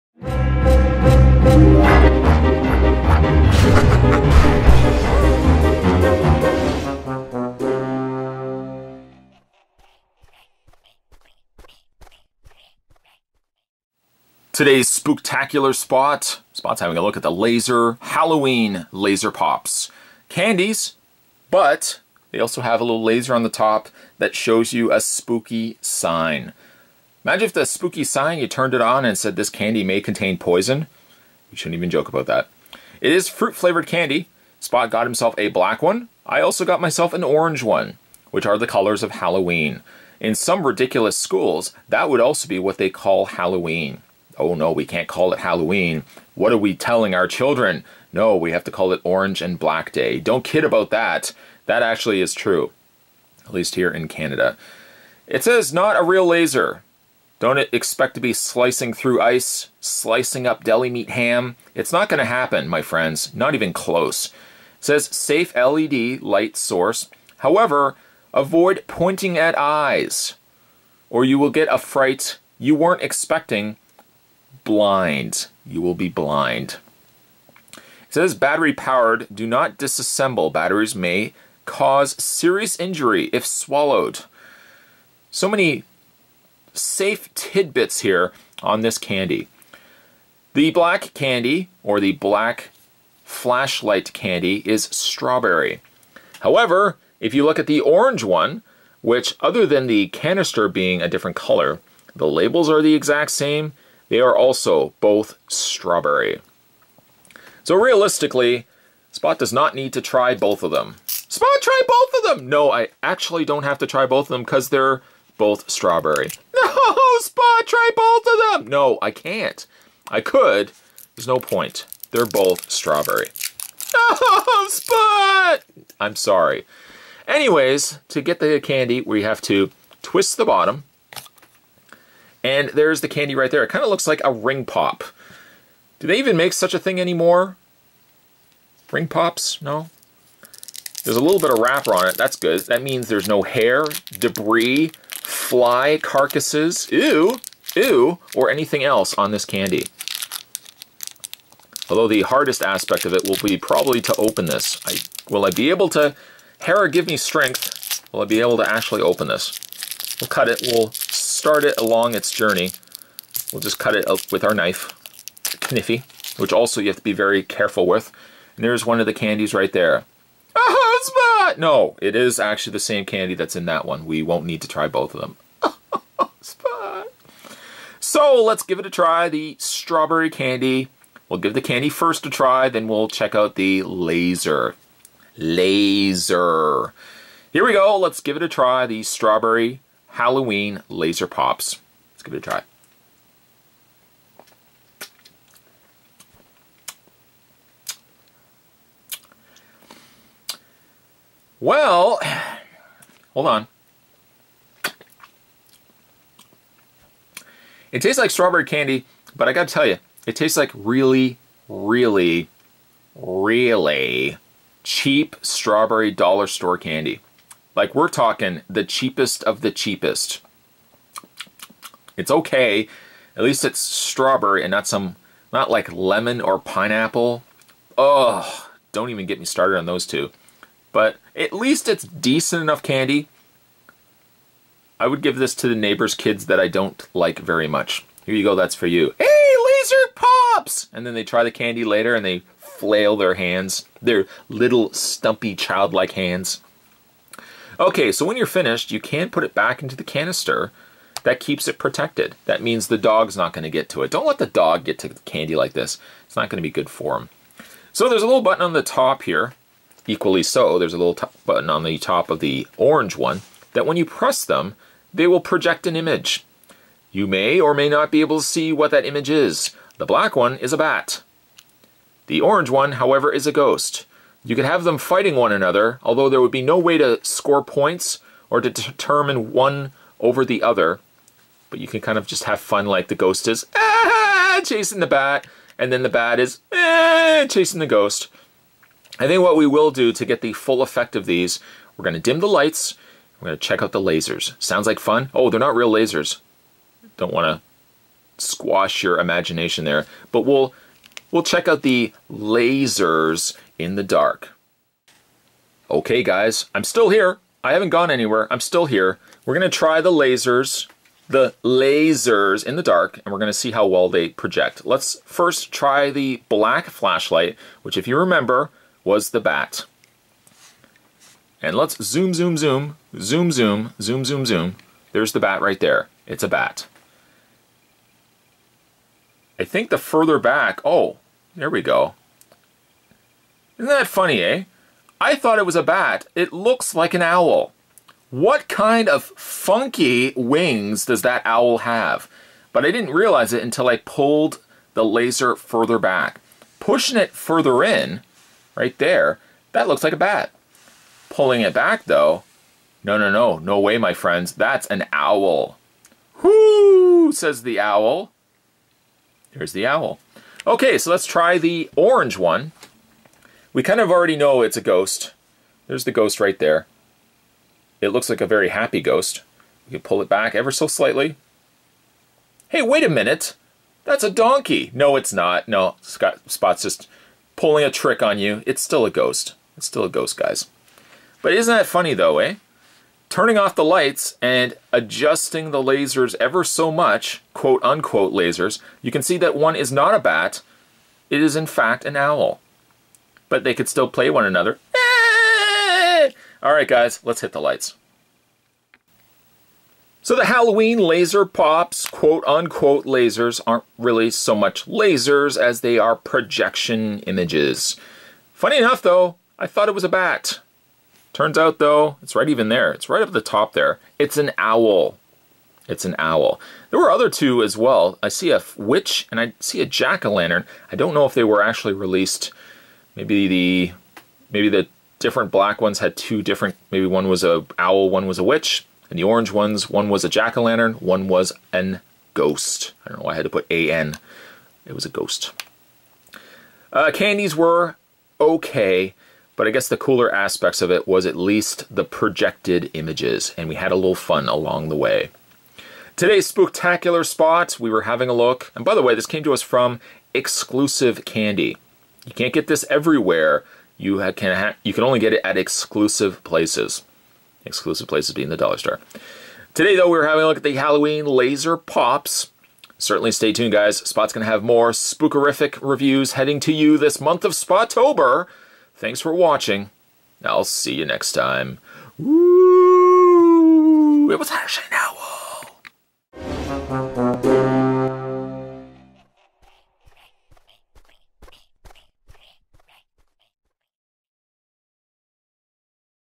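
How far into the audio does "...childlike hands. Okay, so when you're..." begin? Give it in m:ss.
4:05.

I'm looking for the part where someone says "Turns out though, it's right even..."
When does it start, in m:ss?
6:51.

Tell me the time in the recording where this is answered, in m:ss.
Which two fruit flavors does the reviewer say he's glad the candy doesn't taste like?
3:45.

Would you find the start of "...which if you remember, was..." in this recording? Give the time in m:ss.
5:17.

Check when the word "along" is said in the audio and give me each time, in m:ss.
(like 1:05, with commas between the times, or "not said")
2:41, 7:24.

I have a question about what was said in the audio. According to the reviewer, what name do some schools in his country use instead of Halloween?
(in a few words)
Orange and Black Day.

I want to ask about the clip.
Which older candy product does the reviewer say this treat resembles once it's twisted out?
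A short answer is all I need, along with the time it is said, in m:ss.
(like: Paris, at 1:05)
ring pop, at 2:14.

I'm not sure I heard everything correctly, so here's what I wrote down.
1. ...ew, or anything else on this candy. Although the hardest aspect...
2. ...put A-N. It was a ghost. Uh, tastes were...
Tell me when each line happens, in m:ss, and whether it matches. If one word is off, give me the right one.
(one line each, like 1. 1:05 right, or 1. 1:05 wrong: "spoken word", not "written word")
1. 2:27 right
2. 7:13 wrong: "candies", not "tastes".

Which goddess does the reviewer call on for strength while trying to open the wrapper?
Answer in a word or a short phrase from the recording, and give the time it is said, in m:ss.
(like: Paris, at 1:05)
Hera, at 2:36.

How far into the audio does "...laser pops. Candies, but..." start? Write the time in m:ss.
0:18.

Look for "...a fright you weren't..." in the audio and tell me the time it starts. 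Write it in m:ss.
1:11.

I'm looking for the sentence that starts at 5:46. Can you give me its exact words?
Pushing it further in, right there, that looks like a bat.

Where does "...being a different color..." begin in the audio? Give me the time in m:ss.
1:40.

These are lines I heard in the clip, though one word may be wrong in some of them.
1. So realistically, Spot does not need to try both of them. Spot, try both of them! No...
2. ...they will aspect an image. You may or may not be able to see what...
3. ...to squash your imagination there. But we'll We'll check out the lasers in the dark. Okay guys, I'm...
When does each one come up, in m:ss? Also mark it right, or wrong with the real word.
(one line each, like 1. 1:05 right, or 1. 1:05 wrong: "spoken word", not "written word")
1. 1:47 right
2. 4:25 wrong: "project", not "aspect"
3. 4:57 right.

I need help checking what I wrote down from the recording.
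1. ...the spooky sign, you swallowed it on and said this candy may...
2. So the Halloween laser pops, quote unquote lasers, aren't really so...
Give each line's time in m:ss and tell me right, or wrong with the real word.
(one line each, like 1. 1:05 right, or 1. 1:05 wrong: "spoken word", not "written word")
1. 0:27 wrong: "turned", not "swallowed"
2. 6:40 right.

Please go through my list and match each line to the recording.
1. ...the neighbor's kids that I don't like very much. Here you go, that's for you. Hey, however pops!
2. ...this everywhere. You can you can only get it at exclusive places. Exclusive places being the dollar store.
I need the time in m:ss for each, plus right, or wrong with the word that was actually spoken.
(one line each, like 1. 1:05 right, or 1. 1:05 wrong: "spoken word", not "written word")
1. 3:55 wrong: "laser", not "however"
2. 7:32 right.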